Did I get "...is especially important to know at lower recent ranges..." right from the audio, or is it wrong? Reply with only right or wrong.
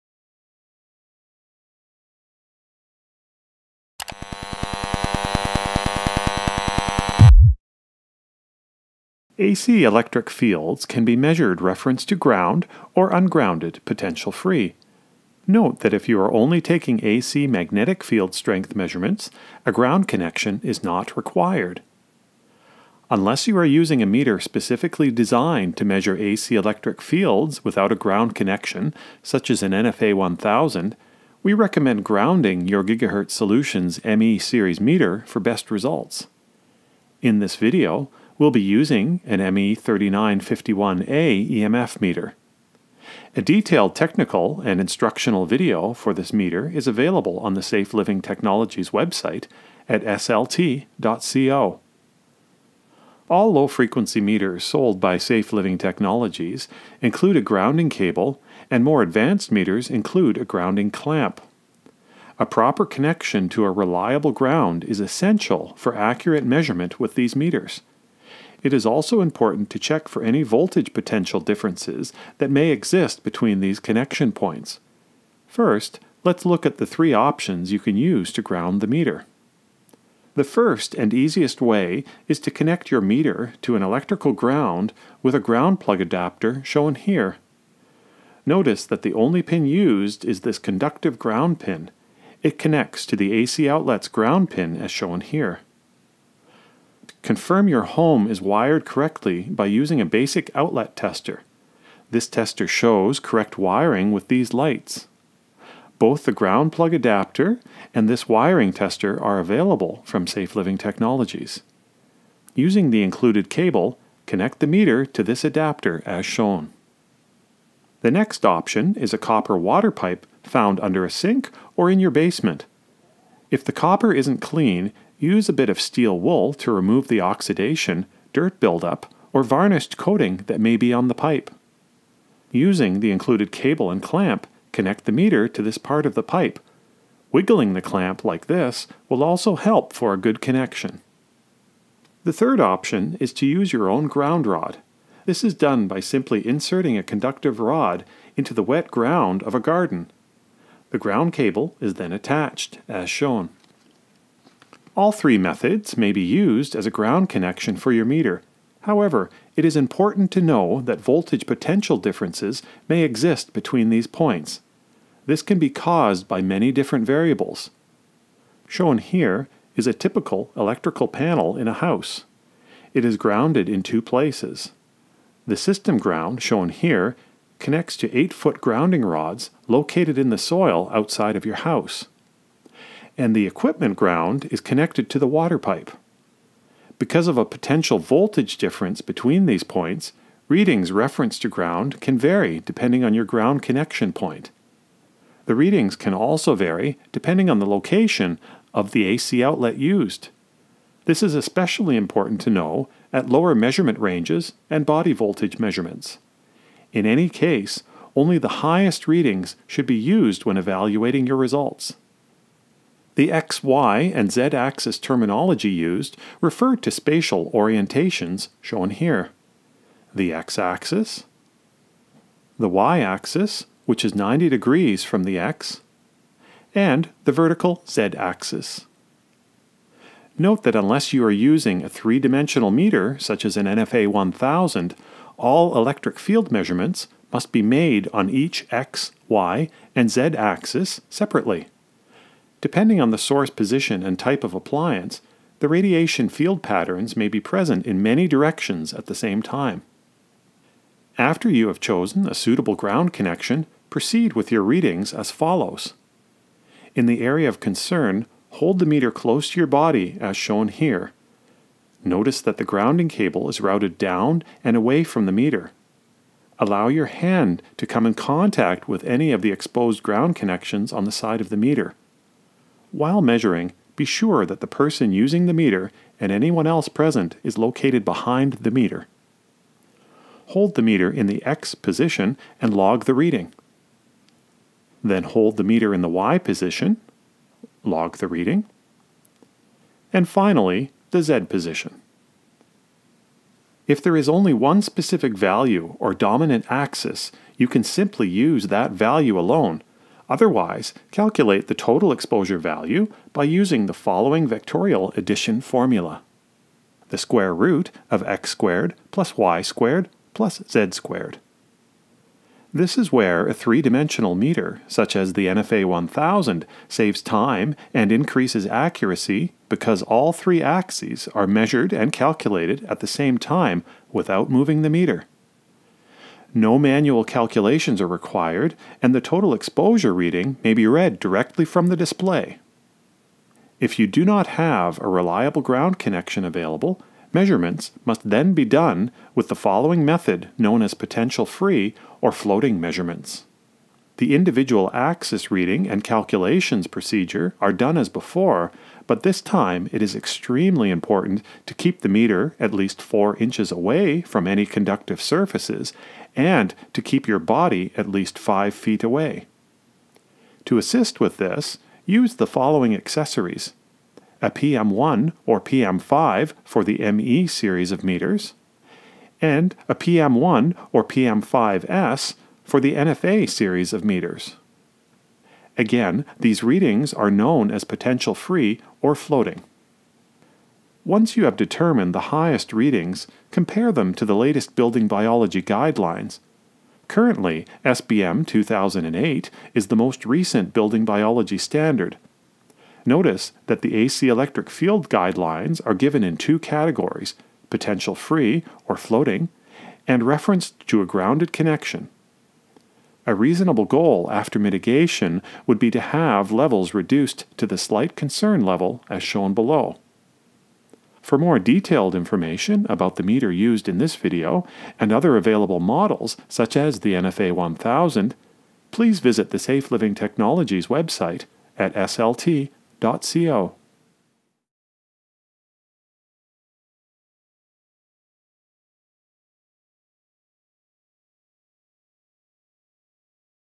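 wrong.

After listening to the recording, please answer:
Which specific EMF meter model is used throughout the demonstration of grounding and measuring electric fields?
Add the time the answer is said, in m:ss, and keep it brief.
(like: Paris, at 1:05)
ME3951A, at 0:39.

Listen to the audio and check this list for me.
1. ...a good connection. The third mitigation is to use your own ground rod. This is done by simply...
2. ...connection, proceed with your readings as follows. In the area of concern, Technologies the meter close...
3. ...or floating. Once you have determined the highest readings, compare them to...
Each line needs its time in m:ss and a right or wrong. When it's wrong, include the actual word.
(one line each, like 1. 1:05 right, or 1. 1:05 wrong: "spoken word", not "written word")
1. 2:20 wrong: "option", not "mitigation"
2. 4:13 wrong: "Hold", not "Technologies"
3. 6:19 right.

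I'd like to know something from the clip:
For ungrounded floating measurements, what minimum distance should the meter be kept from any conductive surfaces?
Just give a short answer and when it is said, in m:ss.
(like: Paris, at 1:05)
4 inches, at 5:53.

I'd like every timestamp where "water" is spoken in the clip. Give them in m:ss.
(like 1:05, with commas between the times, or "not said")
1:59, 3:05.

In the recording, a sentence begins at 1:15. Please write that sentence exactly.
First, let's look at the three options you can use to ground the meter.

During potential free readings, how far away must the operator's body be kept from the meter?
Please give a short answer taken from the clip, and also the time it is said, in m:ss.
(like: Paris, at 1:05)
5 feet, at 5:58.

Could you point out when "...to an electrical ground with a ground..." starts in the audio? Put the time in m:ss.
1:23.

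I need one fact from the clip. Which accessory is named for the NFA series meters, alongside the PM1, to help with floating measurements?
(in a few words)
PM5S.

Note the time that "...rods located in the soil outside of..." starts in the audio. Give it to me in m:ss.
2:59.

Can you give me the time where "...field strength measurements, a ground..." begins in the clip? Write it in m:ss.
0:18.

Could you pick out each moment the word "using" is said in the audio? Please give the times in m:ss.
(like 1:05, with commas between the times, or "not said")
0:23, 0:38, 1:39, 1:52, 2:12, 3:51, 4:35, 5:03.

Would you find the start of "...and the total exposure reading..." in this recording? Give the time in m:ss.
5:29.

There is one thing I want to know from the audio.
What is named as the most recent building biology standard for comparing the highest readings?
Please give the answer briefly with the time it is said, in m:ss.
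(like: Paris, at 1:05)
SBM 2008, at 6:27.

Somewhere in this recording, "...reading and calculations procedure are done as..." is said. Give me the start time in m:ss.
5:45.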